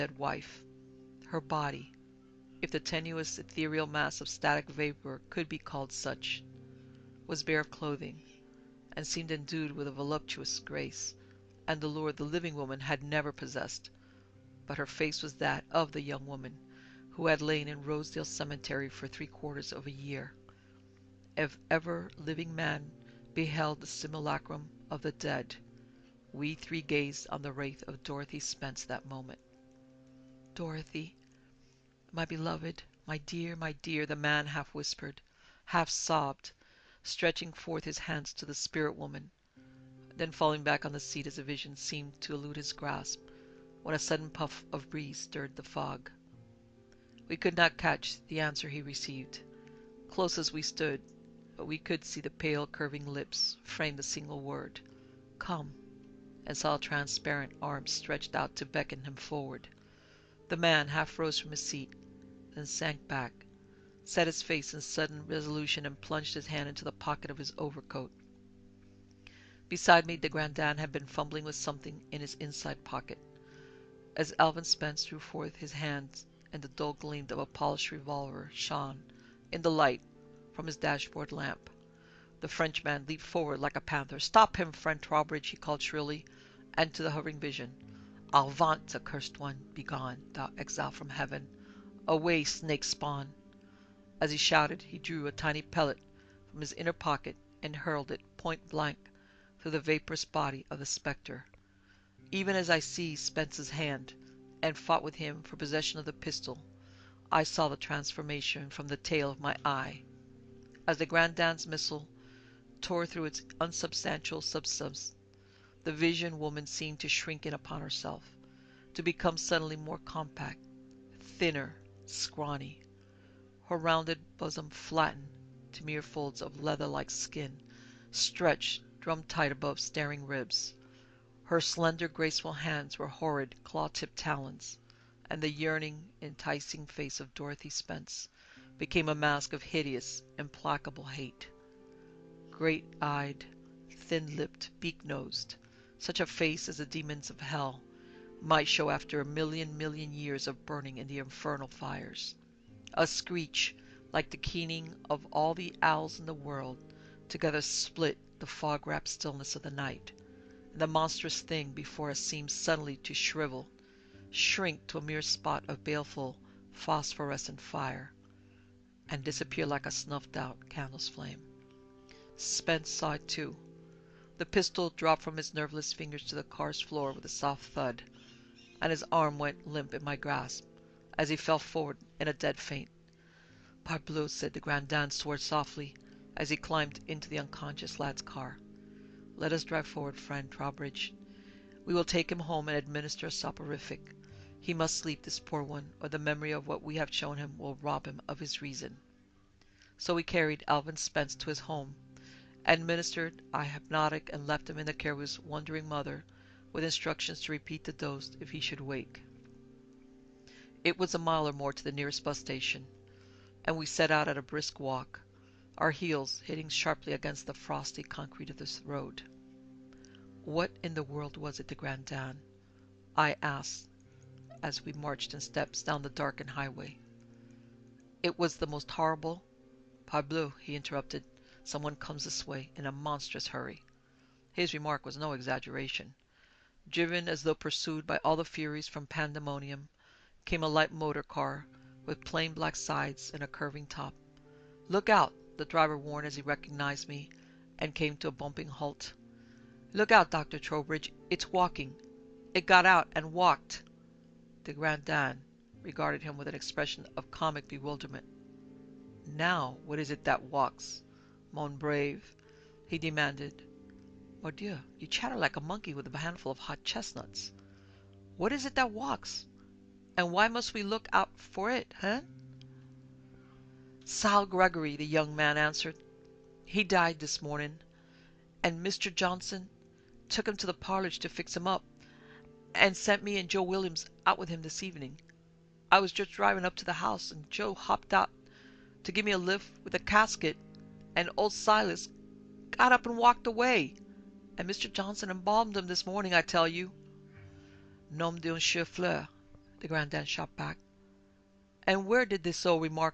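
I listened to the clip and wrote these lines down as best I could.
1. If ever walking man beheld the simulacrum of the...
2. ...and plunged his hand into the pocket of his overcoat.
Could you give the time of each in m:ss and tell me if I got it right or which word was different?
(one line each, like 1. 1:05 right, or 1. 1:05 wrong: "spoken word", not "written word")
1. 0:21 wrong: "living", not "walking"
2. 1:05 right.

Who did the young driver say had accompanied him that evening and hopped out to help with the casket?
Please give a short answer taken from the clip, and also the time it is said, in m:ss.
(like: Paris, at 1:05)
Joe Williams, at 4:43.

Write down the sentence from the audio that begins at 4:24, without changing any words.
"Mordieu, you chatter like a monkey with a handful of hot chestnuts.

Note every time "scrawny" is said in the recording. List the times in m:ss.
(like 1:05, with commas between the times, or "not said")
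2:02.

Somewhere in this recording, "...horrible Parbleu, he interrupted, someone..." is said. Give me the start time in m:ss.
3:48.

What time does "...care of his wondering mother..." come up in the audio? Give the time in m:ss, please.
3:24.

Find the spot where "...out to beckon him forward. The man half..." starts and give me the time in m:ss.
0:58.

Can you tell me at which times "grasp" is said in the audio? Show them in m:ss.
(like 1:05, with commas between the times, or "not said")
0:42, 3:00.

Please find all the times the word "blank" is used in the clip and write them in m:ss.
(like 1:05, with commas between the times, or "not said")
1:38.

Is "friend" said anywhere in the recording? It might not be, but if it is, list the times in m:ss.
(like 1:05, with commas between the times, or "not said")
1:24, 3:10.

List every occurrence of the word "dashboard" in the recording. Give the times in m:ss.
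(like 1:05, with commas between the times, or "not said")
1:20.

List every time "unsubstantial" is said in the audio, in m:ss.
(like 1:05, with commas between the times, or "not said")
1:53.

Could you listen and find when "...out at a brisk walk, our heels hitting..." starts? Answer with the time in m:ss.
3:34.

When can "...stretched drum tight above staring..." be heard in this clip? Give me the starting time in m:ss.
2:08.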